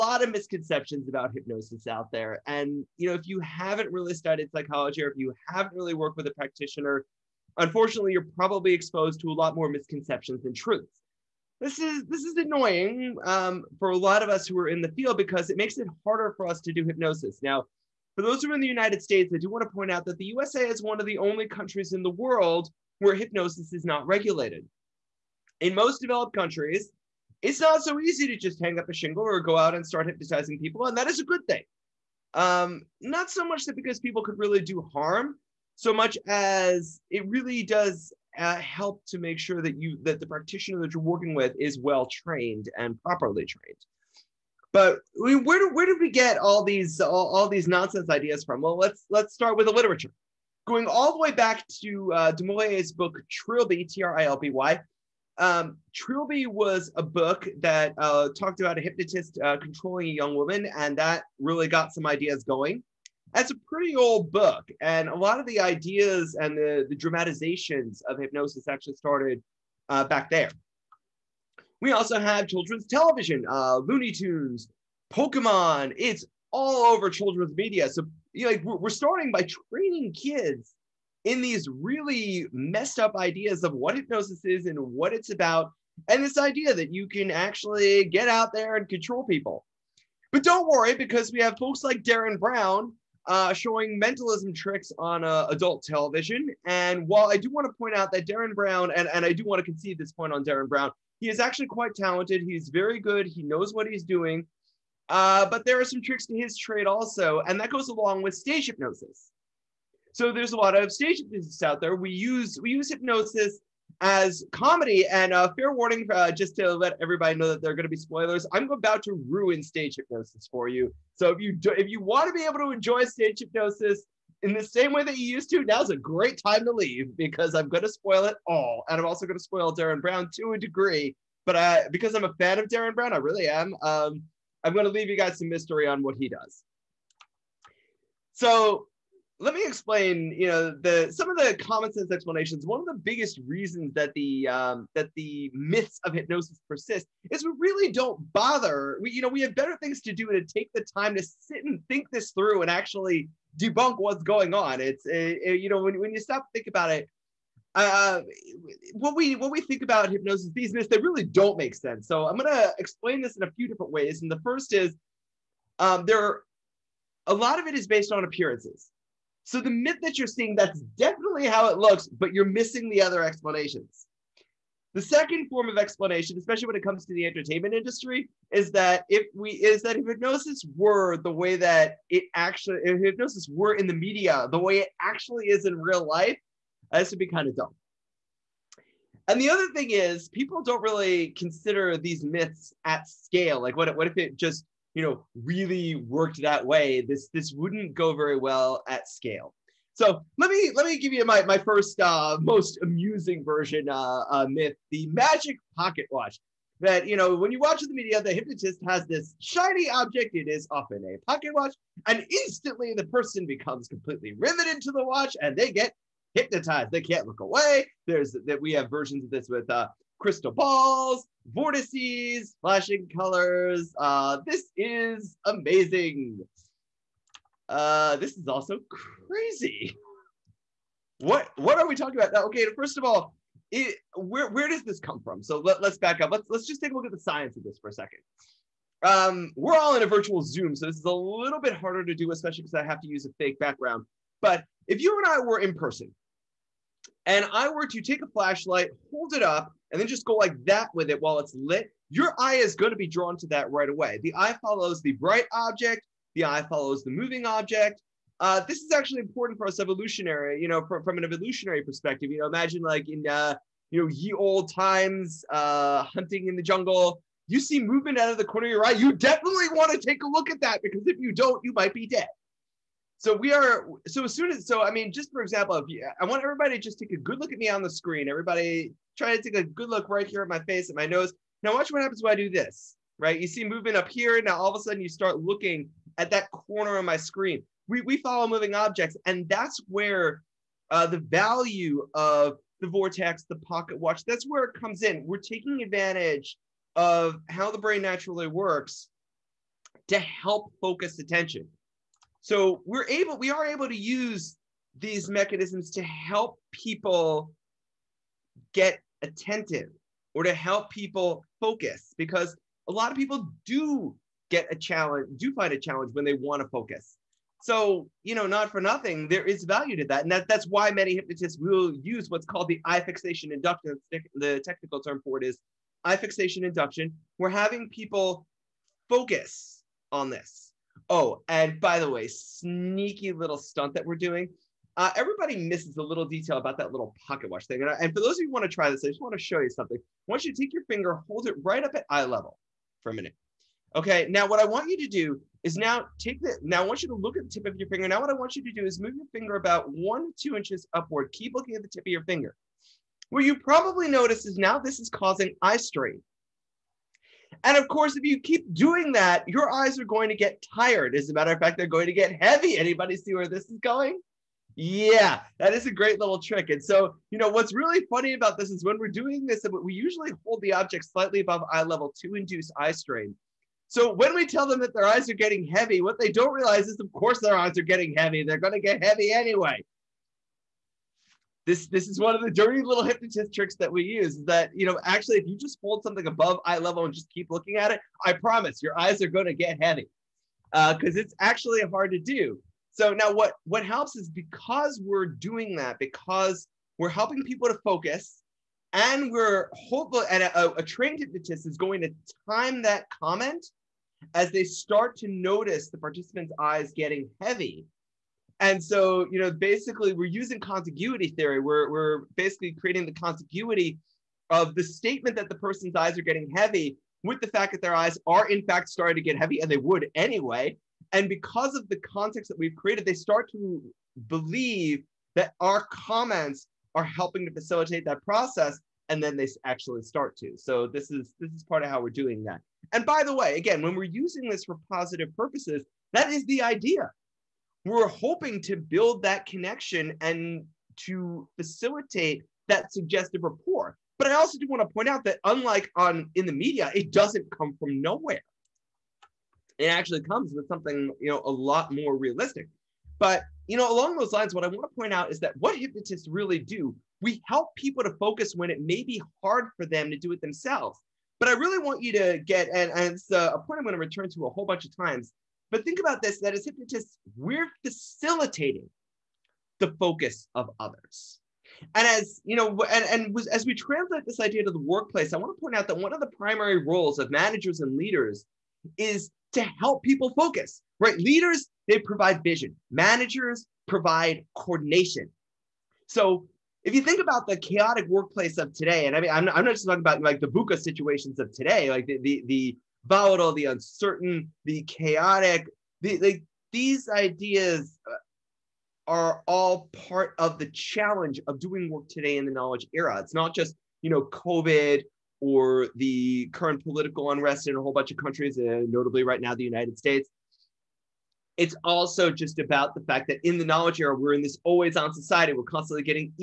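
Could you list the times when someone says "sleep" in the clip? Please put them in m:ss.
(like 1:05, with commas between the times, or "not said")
not said.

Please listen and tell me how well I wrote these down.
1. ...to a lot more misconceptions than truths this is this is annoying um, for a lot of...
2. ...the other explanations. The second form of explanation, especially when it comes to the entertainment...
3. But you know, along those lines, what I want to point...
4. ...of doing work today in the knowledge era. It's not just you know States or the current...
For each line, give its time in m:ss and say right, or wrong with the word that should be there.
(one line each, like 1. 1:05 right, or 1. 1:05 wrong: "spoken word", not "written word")
1. 0:09 right
2. 2:52 right
3. 7:33 right
4. 8:21 wrong: "COVID", not "States".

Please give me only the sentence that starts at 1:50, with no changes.
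So there's a lot of stage hypnosis out there.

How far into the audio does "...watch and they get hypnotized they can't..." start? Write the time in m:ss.
3:35.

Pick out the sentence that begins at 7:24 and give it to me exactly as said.
But I also do want to point out that unlike on in the media, it doesn't come from nowhere.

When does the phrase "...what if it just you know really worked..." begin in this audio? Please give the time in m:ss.
3:13.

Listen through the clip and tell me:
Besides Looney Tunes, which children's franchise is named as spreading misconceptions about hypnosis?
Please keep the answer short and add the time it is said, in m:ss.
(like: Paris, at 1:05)
Pokemon, at 1:15.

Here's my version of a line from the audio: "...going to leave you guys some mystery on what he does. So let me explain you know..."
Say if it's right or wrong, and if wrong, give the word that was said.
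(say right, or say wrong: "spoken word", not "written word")
right.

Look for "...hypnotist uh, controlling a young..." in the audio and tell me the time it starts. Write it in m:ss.
0:58.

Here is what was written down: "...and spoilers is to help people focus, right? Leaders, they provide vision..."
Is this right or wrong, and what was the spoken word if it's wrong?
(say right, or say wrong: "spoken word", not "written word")
wrong: "leaders", not "spoilers".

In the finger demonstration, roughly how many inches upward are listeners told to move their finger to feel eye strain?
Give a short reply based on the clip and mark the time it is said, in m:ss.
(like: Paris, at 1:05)
1 to 2 inches, at 5:49.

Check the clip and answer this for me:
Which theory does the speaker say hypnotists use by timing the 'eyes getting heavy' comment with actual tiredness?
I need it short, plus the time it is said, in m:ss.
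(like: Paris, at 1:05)
contiguity theory, at 6:50.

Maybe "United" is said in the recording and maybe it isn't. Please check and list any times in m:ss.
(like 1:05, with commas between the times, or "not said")
0:18, 8:29.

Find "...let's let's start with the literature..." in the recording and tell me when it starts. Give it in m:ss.
0:48.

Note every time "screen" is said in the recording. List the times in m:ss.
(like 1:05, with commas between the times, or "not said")
4:37, 4:47.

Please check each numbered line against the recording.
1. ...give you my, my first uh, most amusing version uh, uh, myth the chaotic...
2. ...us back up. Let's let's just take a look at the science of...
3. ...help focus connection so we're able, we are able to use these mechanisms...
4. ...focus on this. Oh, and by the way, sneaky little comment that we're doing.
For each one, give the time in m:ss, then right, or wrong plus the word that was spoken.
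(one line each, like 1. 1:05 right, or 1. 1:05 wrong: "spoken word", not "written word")
1. 3:20 wrong: "magic", not "chaotic"
2. 3:55 right
3. 5:00 wrong: "attention", not "connection"
4. 5:29 wrong: "stunt", not "comment".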